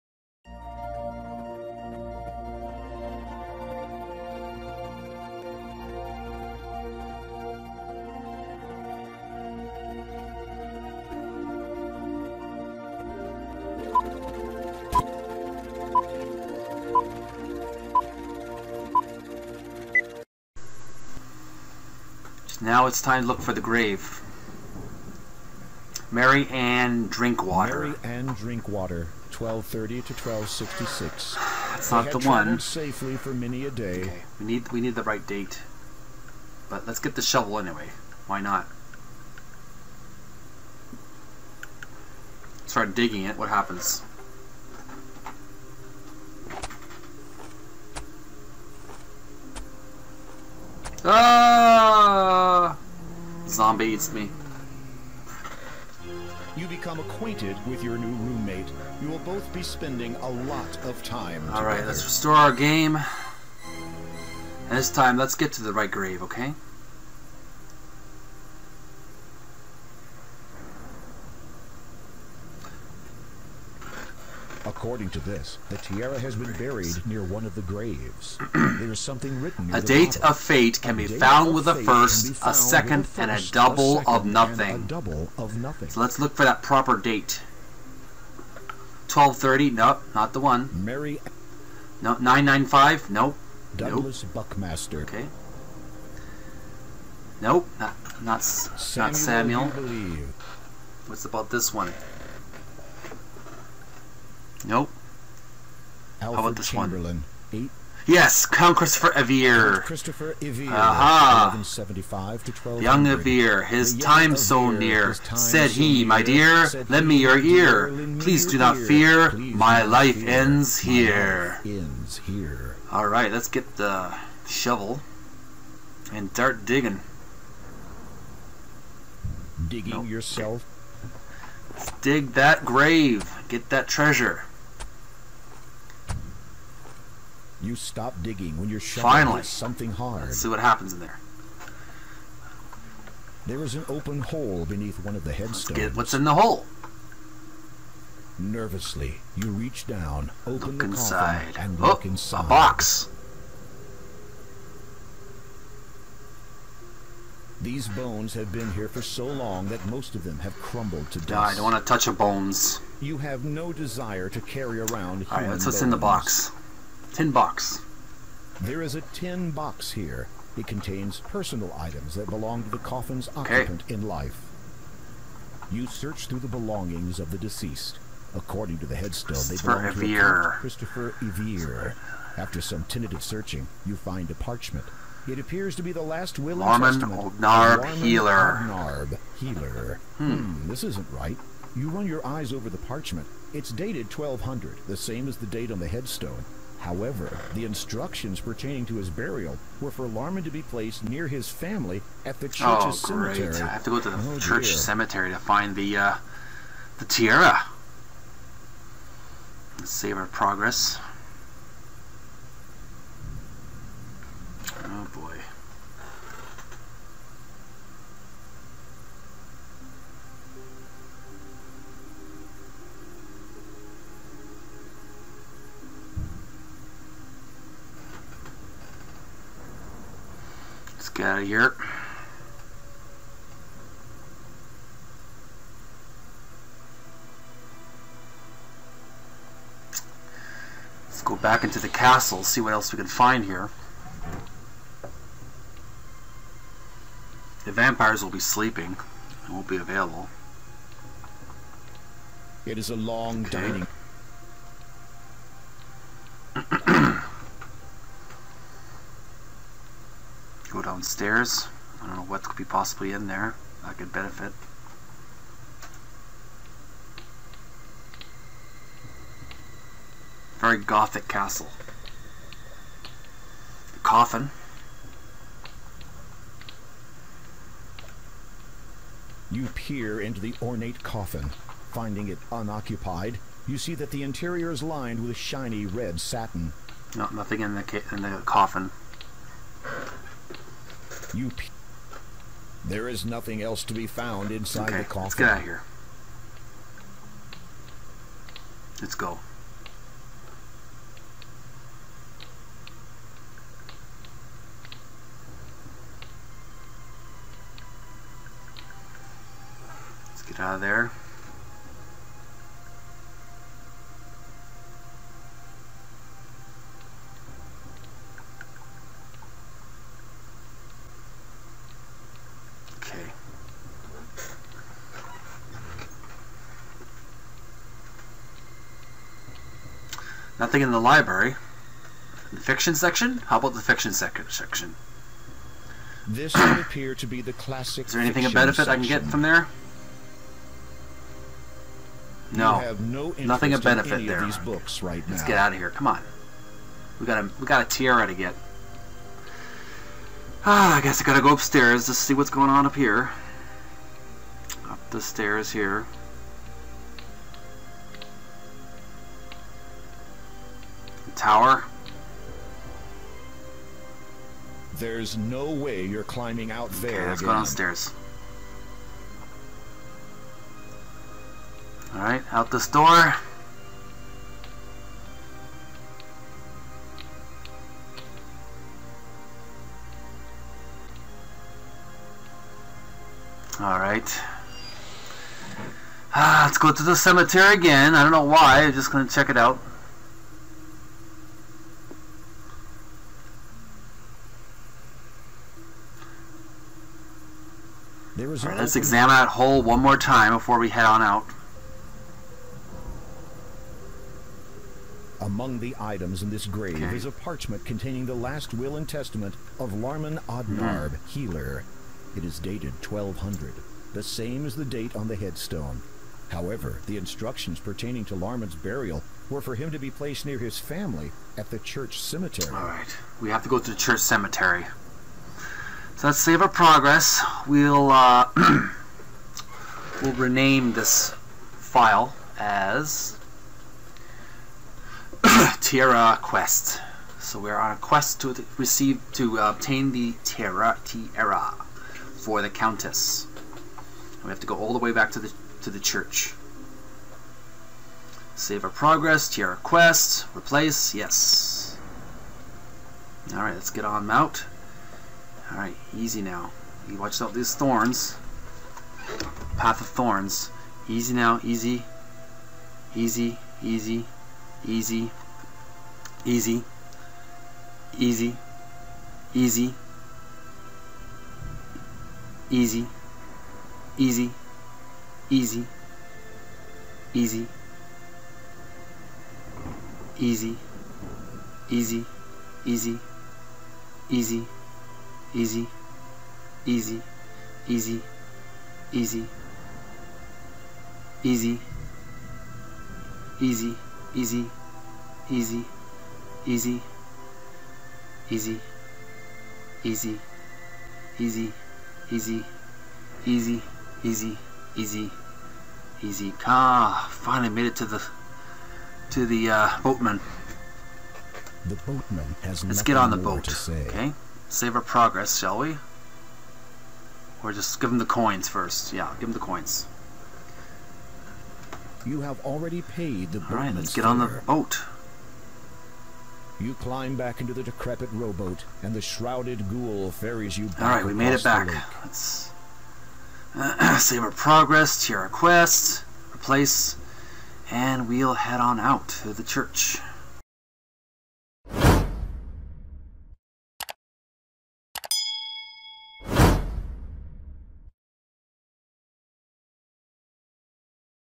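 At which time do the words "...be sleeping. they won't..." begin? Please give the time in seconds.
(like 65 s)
248 s.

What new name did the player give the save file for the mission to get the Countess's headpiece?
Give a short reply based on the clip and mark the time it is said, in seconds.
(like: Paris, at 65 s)
Terra Quest, at 435 s.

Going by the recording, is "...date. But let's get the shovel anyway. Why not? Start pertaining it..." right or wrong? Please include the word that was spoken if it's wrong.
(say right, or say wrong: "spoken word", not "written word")
wrong: "digging", not "pertaining".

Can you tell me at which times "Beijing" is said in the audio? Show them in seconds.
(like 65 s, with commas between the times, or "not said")
not said.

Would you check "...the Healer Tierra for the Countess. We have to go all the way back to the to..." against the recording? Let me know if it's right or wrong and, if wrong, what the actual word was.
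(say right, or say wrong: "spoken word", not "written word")
wrong: "Terra", not "Healer".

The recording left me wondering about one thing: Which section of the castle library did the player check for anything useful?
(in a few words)
Fiction section.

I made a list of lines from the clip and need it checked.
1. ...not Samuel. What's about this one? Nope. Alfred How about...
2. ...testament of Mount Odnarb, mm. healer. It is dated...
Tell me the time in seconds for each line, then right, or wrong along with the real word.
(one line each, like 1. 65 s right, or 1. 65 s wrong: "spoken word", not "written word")
1. 99 s right
2. 409 s wrong: "Larman", not "Mount".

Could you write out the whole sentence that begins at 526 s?
You climb back into the decrepit rowboat, and the shrouded ghoul ferries you back.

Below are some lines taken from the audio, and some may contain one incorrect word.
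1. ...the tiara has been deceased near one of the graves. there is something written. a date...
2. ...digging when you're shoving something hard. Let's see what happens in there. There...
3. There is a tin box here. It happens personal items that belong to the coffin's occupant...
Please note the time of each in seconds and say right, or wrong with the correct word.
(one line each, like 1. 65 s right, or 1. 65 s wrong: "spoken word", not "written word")
1. 75 s wrong: "buried", not "deceased"
2. 138 s right
3. 168 s wrong: "contains", not "happens".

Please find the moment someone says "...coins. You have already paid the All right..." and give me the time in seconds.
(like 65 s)
519 s.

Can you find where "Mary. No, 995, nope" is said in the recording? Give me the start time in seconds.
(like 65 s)
90 s.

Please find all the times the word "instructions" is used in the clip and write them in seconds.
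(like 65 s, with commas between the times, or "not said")
197 s, 417 s.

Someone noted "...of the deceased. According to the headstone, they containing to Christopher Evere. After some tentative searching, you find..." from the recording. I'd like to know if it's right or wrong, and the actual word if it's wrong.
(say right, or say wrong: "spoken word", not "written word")
wrong: "belong", not "containing".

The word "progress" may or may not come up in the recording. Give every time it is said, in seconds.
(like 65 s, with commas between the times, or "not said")
210 s, 426 s, 448 s, 515 s, 534 s.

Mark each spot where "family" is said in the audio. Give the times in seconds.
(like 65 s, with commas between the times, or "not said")
201 s, 420 s.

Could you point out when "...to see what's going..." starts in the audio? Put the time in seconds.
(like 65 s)
352 s.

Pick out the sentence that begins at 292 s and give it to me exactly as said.
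there is nothing else to be found inside okay, the coffin.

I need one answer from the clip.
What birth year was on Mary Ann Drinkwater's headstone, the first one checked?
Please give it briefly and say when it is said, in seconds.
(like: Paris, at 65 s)
1230, at 29 s.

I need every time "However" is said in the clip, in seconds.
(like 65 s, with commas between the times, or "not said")
196 s, 416 s.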